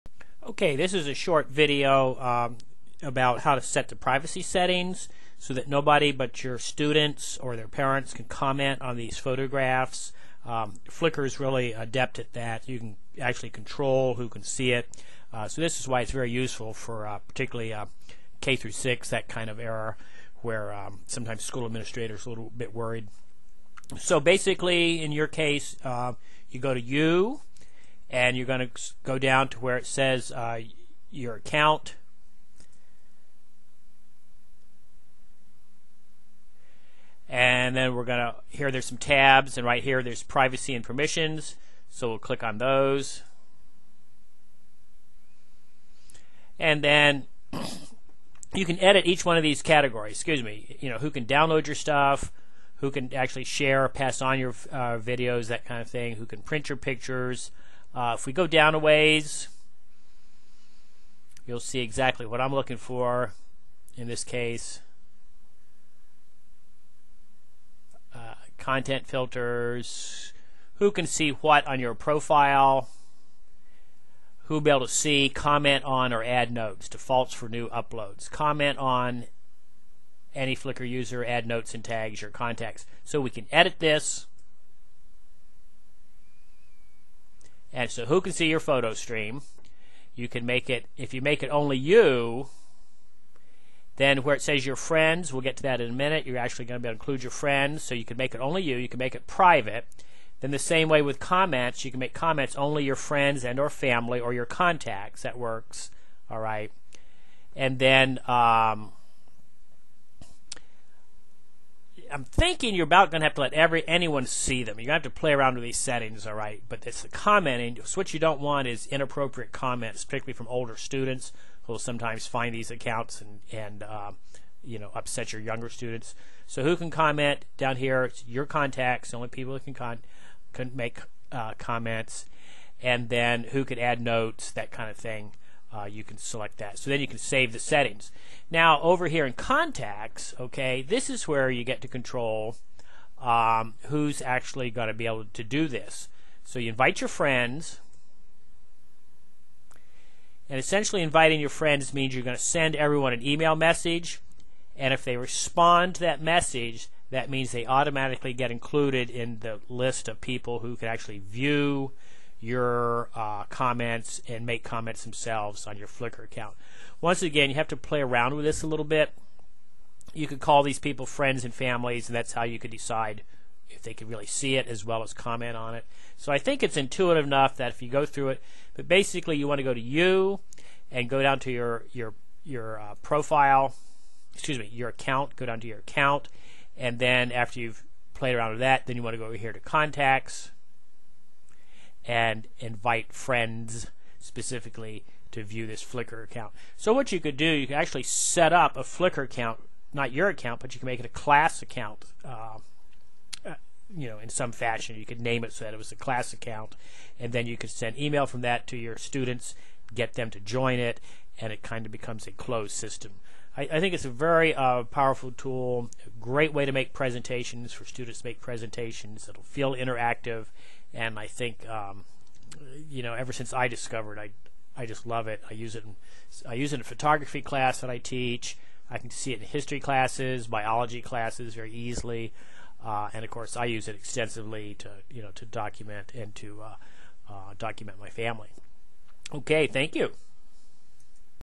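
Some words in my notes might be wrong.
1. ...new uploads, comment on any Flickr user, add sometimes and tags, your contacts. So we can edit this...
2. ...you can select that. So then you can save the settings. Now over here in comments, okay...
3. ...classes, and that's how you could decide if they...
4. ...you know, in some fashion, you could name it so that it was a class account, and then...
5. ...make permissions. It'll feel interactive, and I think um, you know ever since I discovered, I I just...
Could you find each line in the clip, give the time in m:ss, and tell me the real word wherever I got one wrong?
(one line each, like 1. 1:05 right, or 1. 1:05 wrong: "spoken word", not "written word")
1. 1:17 wrong: "notes", not "sometimes"
2. 2:15 wrong: "contacts", not "comments"
3. 2:51 wrong: "families", not "classes"
4. 3:23 right
5. 3:38 wrong: "presentations", not "permissions".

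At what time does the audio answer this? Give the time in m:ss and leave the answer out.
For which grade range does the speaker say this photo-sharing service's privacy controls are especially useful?
0:18.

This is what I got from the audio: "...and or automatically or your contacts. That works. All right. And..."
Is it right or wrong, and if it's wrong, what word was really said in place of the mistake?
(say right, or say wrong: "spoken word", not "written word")
wrong: "family", not "automatically".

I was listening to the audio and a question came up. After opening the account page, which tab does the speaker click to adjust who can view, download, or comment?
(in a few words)
Privacy and permissions.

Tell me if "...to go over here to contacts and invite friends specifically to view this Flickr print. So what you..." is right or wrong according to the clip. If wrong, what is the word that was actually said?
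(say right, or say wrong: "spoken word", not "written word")
wrong: "account", not "print".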